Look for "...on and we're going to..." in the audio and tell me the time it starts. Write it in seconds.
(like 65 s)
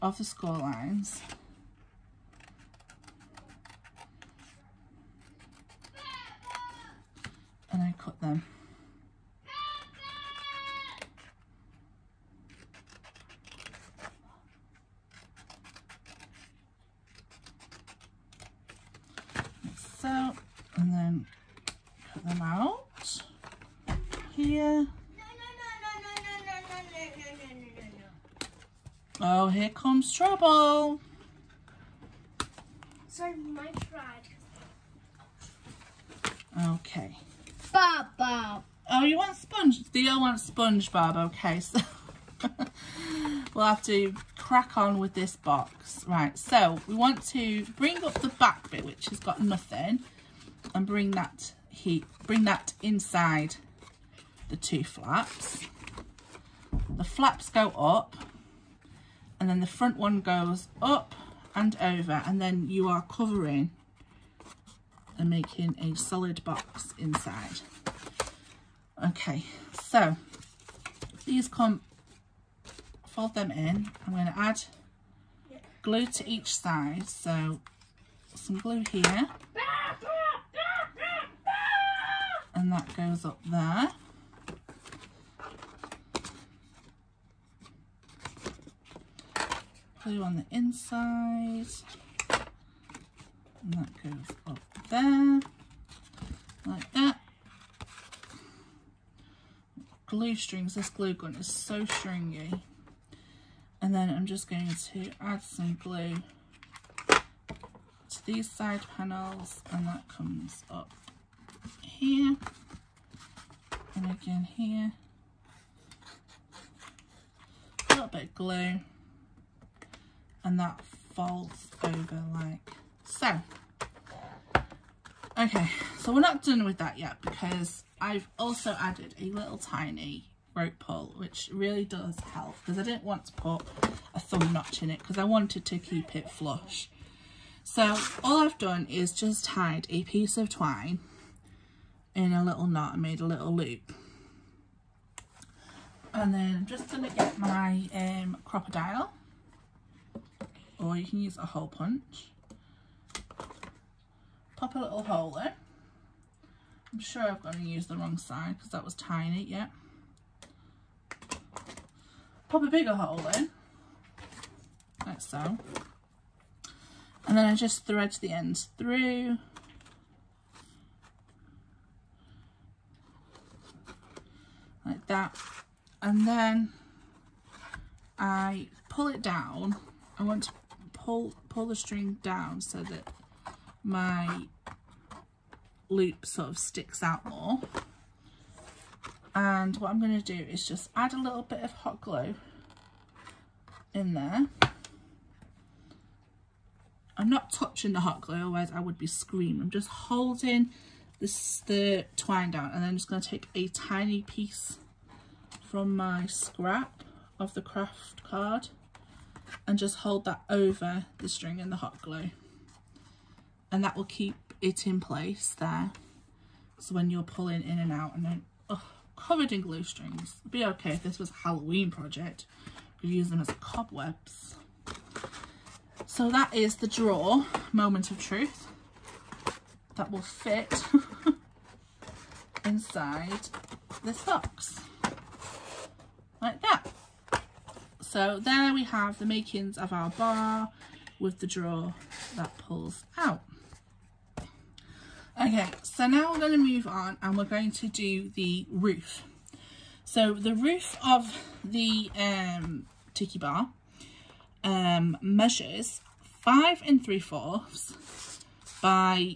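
246 s.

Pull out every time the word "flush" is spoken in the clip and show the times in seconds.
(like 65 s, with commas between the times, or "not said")
136 s.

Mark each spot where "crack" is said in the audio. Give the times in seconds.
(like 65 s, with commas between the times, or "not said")
44 s.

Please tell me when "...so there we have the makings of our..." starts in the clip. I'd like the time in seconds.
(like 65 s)
238 s.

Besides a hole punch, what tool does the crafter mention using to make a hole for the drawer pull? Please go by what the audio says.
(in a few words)
crocodile.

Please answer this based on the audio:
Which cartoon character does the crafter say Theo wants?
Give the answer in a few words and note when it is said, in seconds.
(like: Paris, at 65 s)
SpongeBob, at 40 s.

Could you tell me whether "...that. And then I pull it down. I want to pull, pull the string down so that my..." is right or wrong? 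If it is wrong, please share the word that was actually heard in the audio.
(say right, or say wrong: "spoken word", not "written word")
right.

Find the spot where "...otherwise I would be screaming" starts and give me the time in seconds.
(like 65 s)
198 s.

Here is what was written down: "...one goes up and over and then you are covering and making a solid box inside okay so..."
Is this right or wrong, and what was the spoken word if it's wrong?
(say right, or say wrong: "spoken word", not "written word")
right.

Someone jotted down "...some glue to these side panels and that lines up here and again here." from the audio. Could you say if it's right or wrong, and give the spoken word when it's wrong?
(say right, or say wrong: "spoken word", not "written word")
wrong: "comes", not "lines".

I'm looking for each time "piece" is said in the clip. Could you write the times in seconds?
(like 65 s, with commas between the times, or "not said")
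140 s, 204 s.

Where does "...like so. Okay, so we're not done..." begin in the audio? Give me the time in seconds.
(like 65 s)
122 s.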